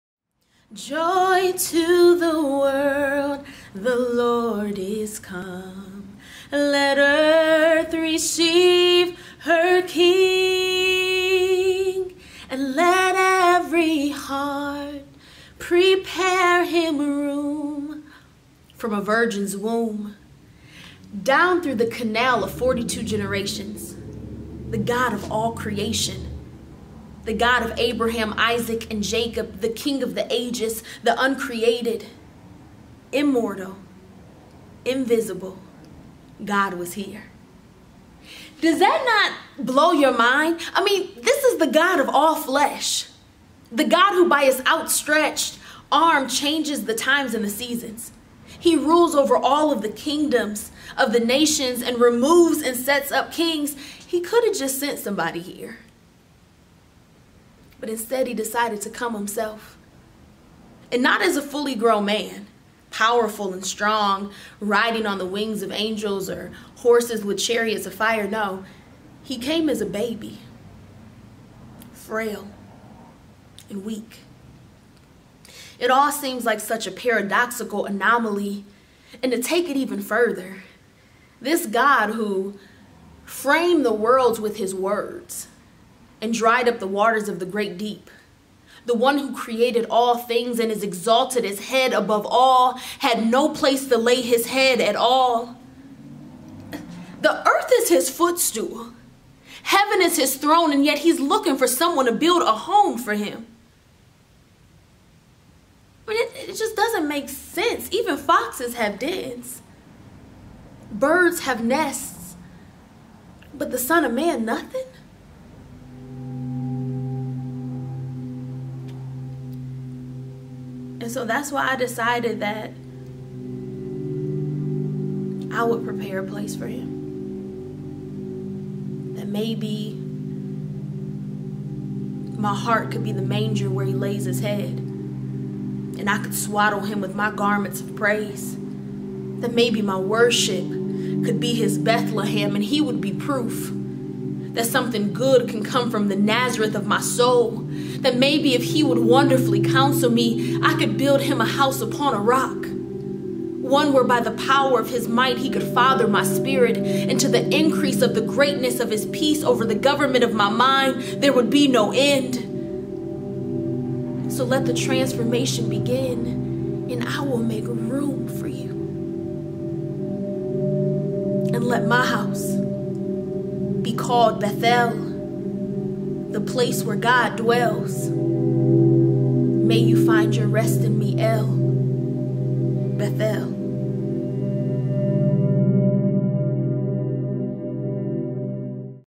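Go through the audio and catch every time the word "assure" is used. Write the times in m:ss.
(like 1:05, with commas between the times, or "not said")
not said.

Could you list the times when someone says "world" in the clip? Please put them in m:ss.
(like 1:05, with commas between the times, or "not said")
0:02, 1:23.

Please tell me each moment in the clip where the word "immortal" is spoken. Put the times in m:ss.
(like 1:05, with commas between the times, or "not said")
0:33.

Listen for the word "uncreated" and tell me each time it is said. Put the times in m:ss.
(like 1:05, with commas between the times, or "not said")
0:31.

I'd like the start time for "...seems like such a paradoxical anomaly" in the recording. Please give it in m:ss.
1:16.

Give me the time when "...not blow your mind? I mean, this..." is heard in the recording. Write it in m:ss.
0:39.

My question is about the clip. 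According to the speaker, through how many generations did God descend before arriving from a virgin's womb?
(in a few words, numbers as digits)
42.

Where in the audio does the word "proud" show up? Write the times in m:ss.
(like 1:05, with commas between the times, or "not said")
not said.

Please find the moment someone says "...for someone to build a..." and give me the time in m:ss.
1:41.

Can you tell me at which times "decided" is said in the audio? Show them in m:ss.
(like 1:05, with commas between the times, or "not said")
0:58, 2:01.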